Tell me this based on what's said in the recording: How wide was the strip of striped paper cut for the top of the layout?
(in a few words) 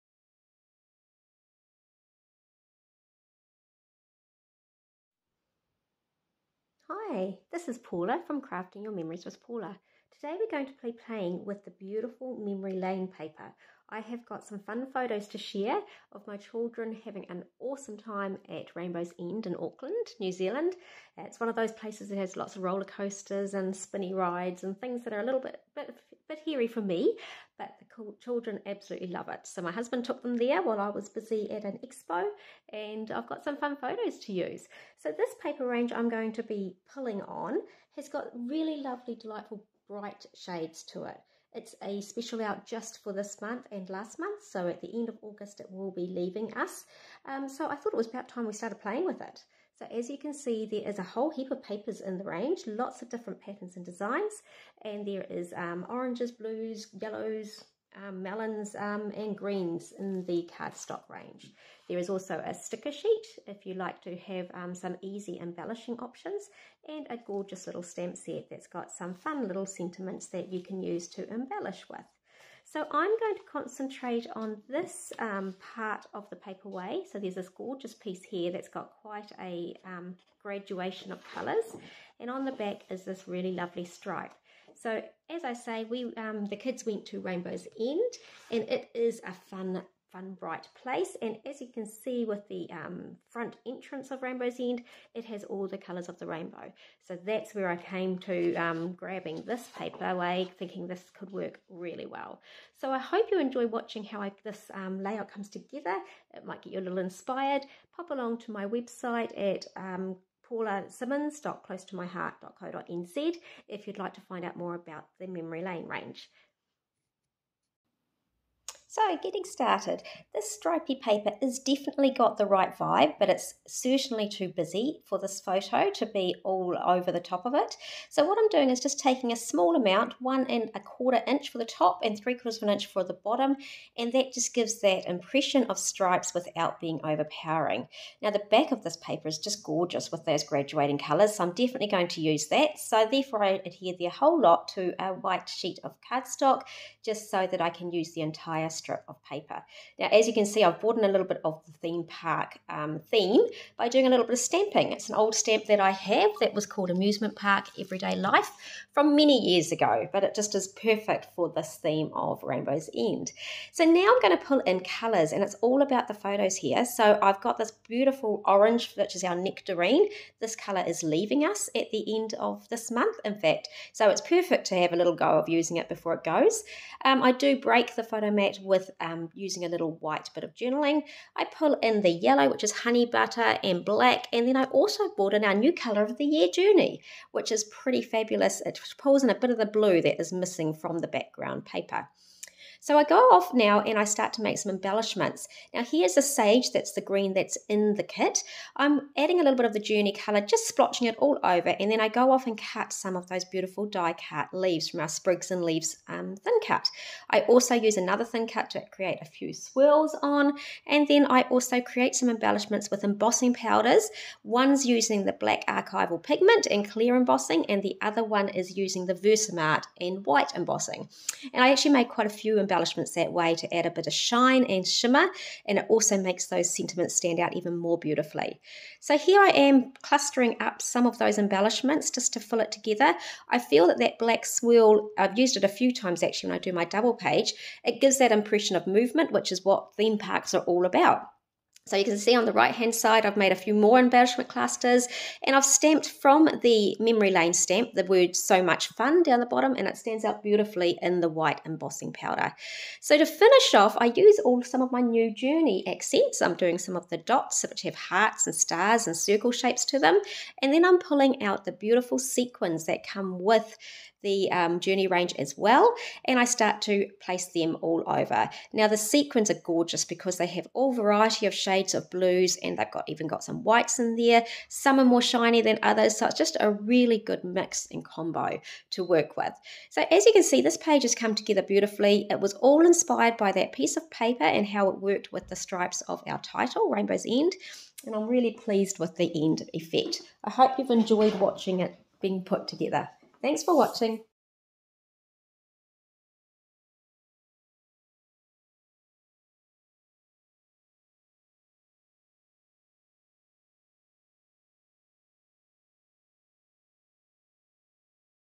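1 1/4 inch.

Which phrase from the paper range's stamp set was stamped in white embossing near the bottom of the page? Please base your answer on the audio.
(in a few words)
so much fun.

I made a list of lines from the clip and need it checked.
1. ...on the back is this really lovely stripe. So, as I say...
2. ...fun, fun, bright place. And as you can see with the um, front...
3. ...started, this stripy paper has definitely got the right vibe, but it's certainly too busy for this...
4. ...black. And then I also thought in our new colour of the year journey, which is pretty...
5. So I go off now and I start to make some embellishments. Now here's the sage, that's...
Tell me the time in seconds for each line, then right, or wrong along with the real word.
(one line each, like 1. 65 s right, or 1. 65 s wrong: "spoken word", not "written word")
1. 82 s right
2. 89 s right
3. 119 s right
4. 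183 s wrong: "bought", not "thought"
5. 192 s right.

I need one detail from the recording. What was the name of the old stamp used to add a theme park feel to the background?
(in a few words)
Amusement Park Everyday Life.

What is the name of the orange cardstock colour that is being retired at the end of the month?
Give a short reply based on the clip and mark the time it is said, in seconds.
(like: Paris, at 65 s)
nectarine, at 169 s.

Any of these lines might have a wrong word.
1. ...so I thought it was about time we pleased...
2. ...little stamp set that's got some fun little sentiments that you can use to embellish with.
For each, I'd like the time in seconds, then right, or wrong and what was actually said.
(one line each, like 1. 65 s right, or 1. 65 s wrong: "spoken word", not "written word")
1. 47 s wrong: "started", not "pleased"
2. 67 s right.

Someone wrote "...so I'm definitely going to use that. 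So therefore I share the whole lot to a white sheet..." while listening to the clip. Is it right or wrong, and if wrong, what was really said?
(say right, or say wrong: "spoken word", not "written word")
wrong: "adhere", not "share".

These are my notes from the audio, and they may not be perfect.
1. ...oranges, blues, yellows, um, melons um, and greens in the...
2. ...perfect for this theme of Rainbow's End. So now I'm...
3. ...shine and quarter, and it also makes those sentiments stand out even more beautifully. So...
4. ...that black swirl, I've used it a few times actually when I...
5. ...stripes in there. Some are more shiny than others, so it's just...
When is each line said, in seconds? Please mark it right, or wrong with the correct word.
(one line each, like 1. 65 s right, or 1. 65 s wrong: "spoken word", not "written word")
1. 55 s right
2. 160 s right
3. 224 s wrong: "shimmer", not "quarter"
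4. 233 s right
5. 273 s wrong: "whites", not "stripes".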